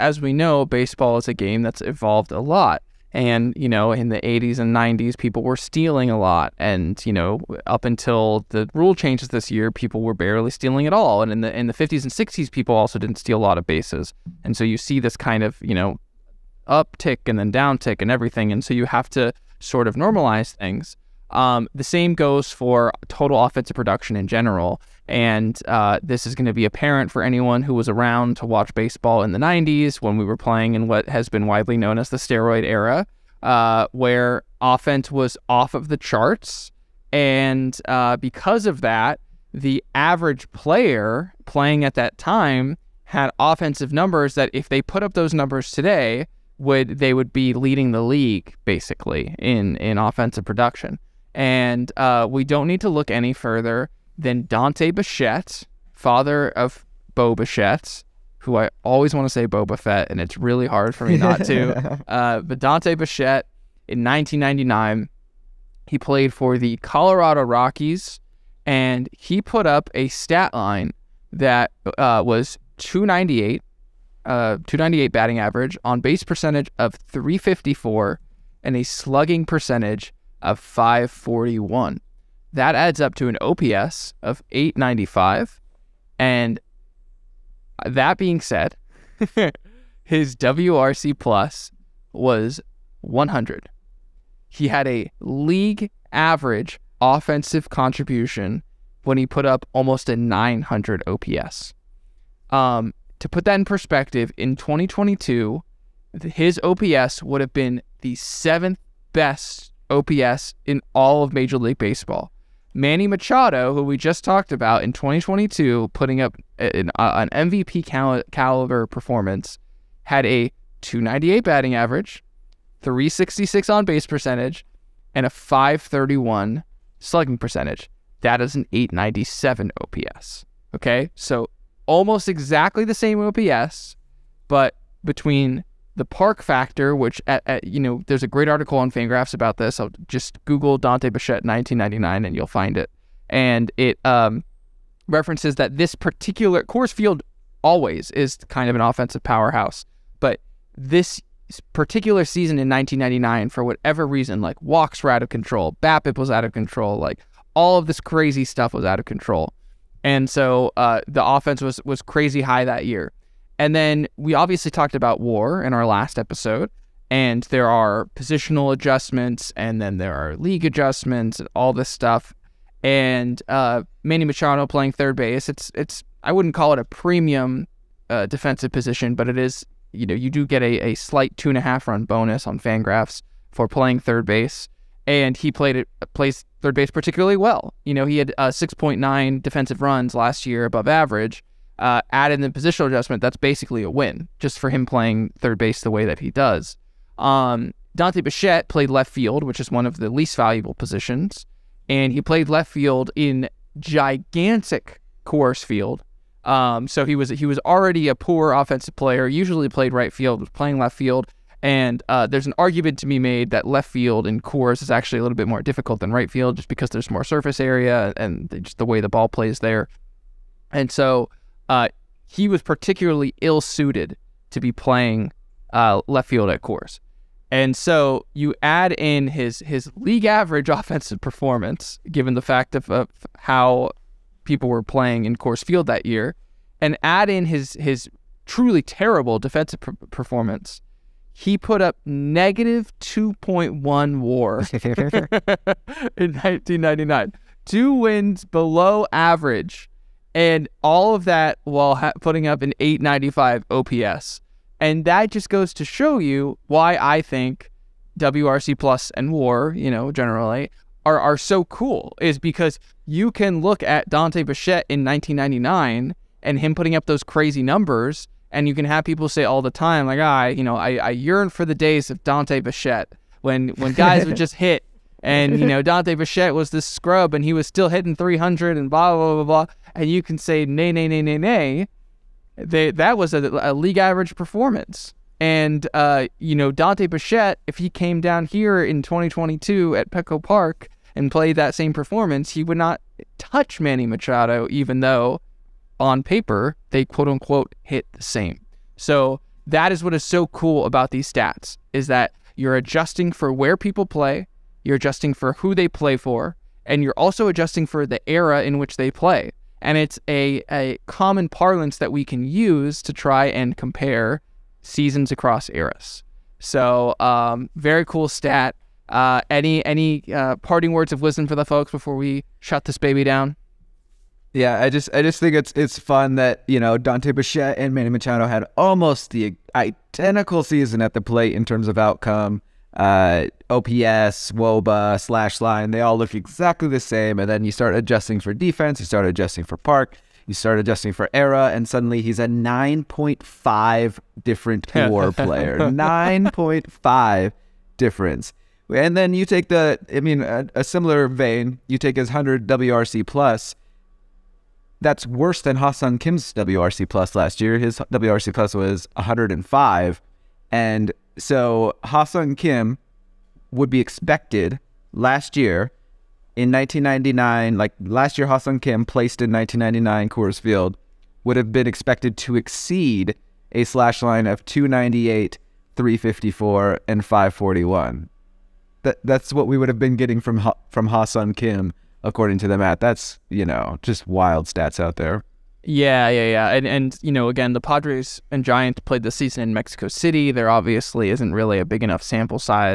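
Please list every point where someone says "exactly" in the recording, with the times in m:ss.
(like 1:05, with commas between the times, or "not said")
2:12, 5:36.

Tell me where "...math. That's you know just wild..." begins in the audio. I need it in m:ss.
6:22.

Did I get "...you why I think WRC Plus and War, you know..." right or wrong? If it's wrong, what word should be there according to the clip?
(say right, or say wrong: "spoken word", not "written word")
right.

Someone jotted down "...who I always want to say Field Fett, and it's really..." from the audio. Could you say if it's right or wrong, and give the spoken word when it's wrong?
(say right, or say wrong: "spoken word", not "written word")
wrong: "Boba", not "Field".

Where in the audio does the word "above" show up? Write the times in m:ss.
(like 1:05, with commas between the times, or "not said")
3:10.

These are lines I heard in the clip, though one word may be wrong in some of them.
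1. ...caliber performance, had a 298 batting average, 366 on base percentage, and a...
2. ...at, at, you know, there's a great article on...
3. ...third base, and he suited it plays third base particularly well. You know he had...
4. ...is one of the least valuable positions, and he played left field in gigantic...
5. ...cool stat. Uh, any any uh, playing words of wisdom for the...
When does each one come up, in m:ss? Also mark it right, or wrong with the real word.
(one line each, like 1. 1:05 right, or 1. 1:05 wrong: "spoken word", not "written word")
1. 1:58 right
2. 2:17 right
3. 3:04 wrong: "played", not "suited"
4. 3:19 right
5. 5:18 wrong: "parting", not "playing".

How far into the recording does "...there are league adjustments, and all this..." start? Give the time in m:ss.
2:49.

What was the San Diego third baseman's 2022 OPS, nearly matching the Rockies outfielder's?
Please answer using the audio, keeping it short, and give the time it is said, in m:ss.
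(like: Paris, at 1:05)
897, at 2:08.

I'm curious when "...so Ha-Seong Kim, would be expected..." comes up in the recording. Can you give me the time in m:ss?
6:01.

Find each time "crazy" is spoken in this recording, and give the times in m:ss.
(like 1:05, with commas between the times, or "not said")
2:38, 2:42, 4:27.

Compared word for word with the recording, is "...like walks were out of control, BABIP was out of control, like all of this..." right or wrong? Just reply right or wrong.
right.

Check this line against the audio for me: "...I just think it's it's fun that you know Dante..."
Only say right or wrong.
right.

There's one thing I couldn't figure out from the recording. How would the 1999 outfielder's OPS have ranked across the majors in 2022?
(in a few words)
Seventh best.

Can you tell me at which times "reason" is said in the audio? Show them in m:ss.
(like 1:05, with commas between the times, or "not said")
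2:34.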